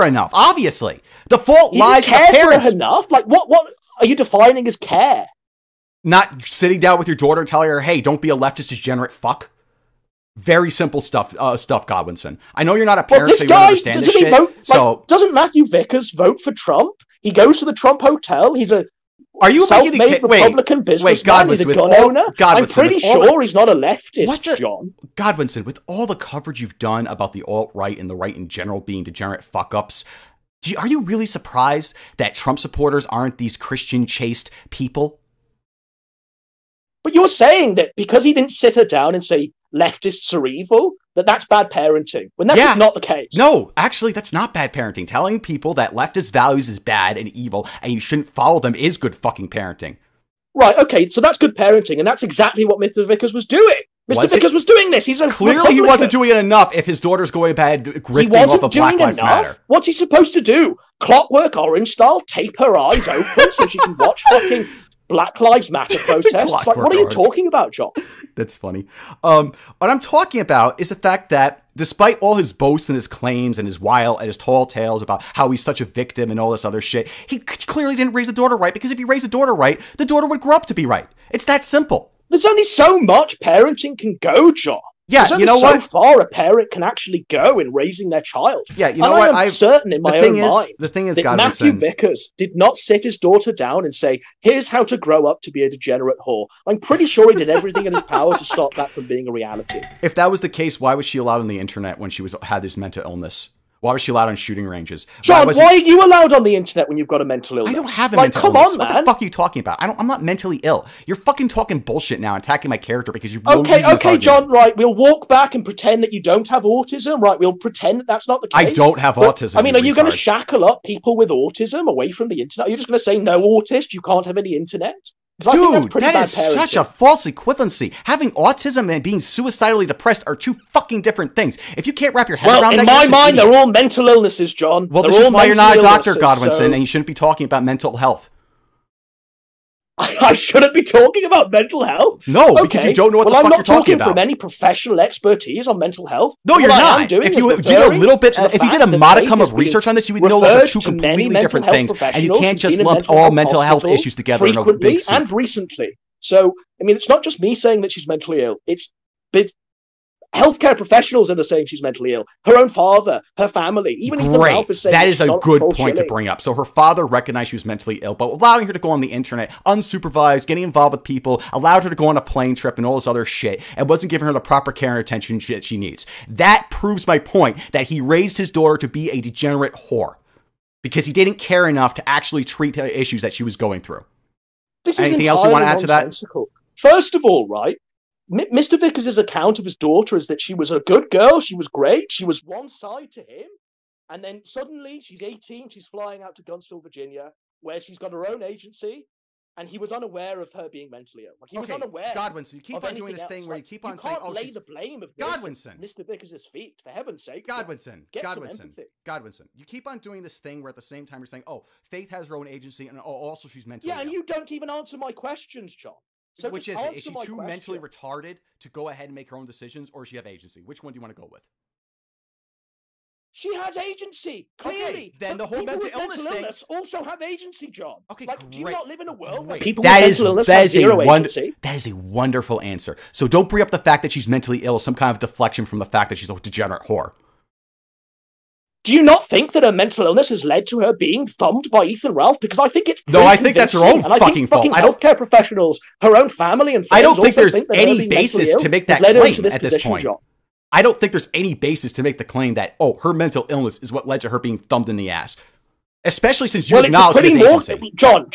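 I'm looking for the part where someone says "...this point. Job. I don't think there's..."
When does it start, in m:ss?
4:09.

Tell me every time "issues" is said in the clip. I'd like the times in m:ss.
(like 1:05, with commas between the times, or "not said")
2:33, 3:02.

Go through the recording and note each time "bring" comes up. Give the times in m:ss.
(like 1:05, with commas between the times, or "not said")
2:46, 3:53.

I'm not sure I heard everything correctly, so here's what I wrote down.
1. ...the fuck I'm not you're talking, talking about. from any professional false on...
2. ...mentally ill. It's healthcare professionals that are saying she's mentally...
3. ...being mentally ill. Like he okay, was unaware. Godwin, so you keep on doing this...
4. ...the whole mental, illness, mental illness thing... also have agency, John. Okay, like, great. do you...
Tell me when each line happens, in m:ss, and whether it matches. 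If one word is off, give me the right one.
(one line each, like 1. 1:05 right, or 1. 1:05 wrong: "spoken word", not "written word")
1. 2:23 wrong: "expertise", not "false"
2. 2:38 right
3. 3:20 right
4. 3:45 right.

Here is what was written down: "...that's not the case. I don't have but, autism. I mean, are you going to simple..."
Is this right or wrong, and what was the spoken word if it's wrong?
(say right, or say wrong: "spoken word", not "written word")
wrong: "shackle", not "simple".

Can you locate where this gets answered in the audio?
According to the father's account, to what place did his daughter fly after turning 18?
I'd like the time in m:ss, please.
3:16.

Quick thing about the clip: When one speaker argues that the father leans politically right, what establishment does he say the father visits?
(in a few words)
Trump hotel.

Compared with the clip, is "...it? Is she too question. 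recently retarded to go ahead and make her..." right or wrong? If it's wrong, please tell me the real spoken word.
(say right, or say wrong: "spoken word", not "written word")
wrong: "mentally", not "recently".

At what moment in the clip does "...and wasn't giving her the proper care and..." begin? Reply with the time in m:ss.
2:53.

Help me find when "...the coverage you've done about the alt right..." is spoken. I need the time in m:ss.
0:26.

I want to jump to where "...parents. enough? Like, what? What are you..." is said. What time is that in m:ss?
0:02.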